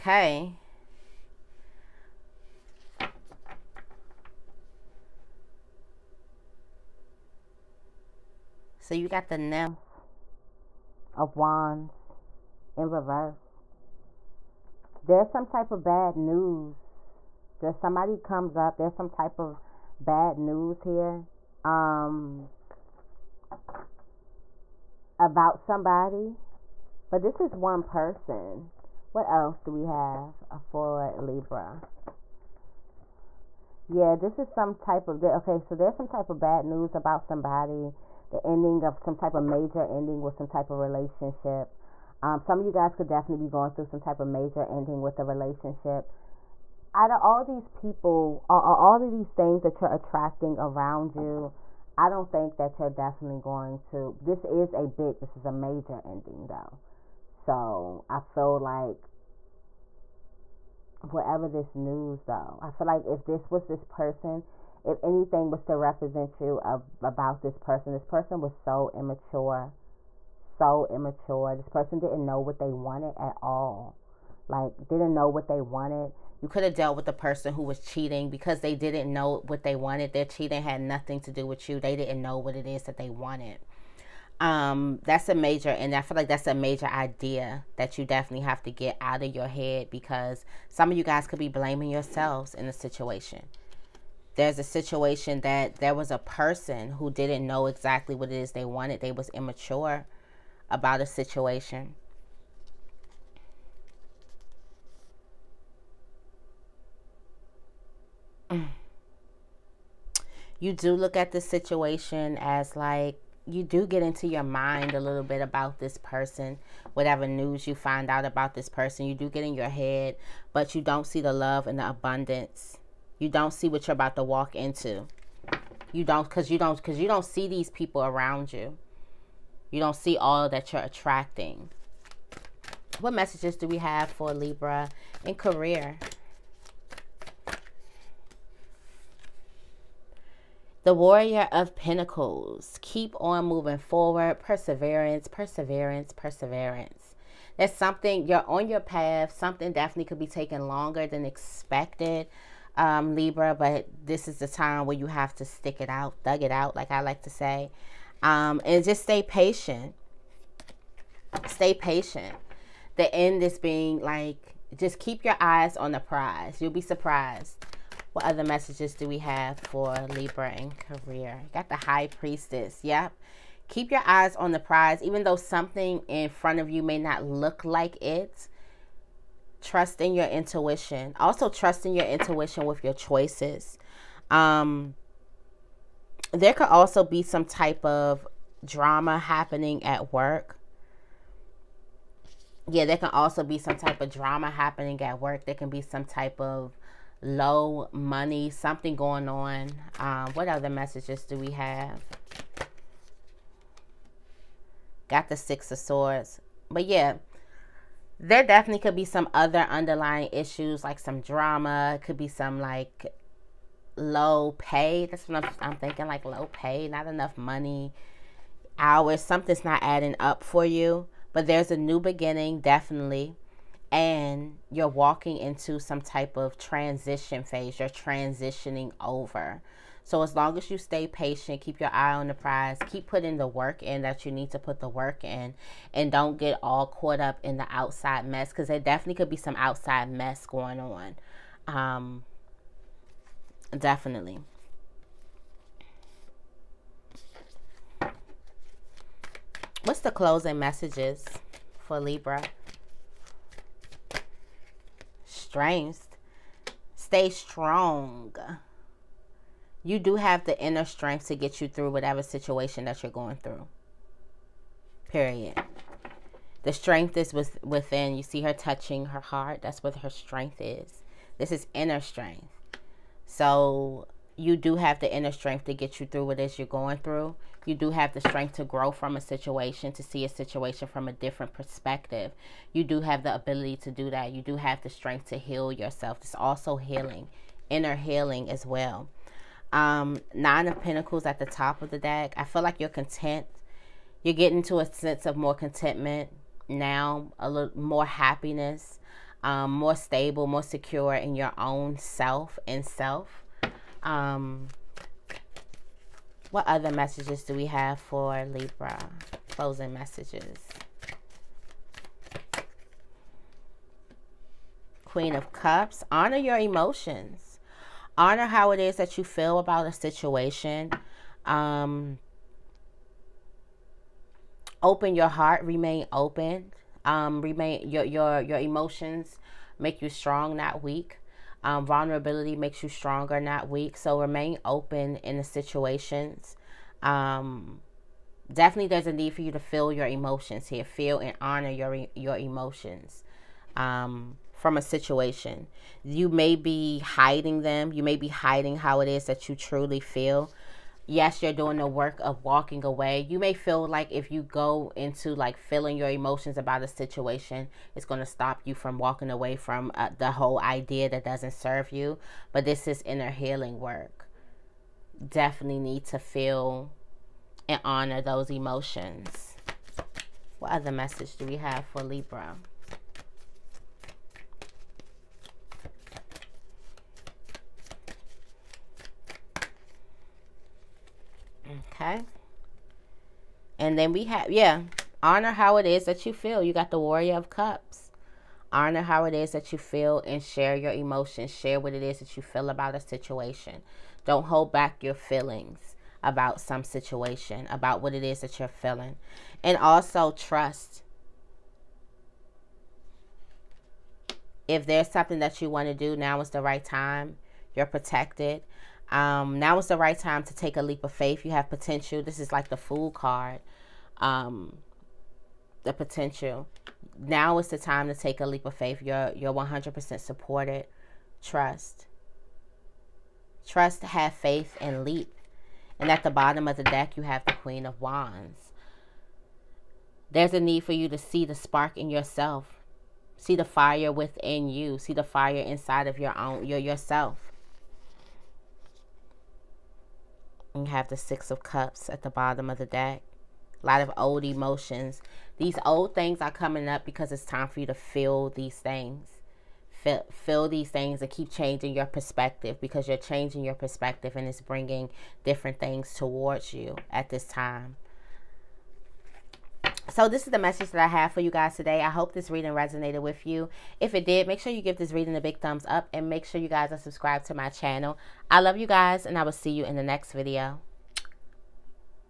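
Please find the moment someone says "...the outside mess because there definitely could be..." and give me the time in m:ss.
3:57.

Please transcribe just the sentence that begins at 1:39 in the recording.
They was immature about a situation.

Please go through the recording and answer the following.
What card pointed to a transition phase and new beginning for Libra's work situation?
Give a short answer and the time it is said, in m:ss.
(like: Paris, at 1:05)
Six of Swords, at 3:25.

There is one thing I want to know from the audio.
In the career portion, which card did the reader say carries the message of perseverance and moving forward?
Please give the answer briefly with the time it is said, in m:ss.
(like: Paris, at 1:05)
Warrior of Pentacles, at 2:20.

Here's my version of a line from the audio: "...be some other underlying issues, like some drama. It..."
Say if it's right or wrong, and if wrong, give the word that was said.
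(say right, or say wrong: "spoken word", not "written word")
right.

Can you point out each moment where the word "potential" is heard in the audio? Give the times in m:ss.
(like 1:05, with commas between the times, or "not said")
6:51, 6:55.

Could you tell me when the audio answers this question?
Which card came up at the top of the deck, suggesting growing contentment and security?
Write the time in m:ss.
4:50.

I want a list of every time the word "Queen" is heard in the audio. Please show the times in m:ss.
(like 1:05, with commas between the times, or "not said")
5:15, 7:07.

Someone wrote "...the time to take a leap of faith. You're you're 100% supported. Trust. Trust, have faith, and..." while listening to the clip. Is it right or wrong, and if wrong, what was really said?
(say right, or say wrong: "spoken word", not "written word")
right.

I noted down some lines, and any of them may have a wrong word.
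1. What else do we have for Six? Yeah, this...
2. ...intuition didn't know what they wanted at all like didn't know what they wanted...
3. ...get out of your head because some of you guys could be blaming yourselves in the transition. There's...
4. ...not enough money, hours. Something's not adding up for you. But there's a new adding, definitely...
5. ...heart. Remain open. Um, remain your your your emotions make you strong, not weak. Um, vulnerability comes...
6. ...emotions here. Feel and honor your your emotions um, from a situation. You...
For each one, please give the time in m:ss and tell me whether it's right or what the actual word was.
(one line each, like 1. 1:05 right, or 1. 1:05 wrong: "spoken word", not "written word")
1. 0:29 wrong: "Libra", not "Six"
2. 1:11 wrong: "person", not "intuition"
3. 1:28 wrong: "situation", not "transition"
4. 3:36 wrong: "beginning", not "adding"
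5. 5:25 wrong: "makes", not "comes"
6. 5:40 right.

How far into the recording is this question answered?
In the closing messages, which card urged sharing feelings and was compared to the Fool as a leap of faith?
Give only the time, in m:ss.
6:26.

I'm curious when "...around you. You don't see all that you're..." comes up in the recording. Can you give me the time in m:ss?
2:08.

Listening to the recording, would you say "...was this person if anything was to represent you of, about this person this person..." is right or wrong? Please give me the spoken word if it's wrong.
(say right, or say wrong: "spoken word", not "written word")
right.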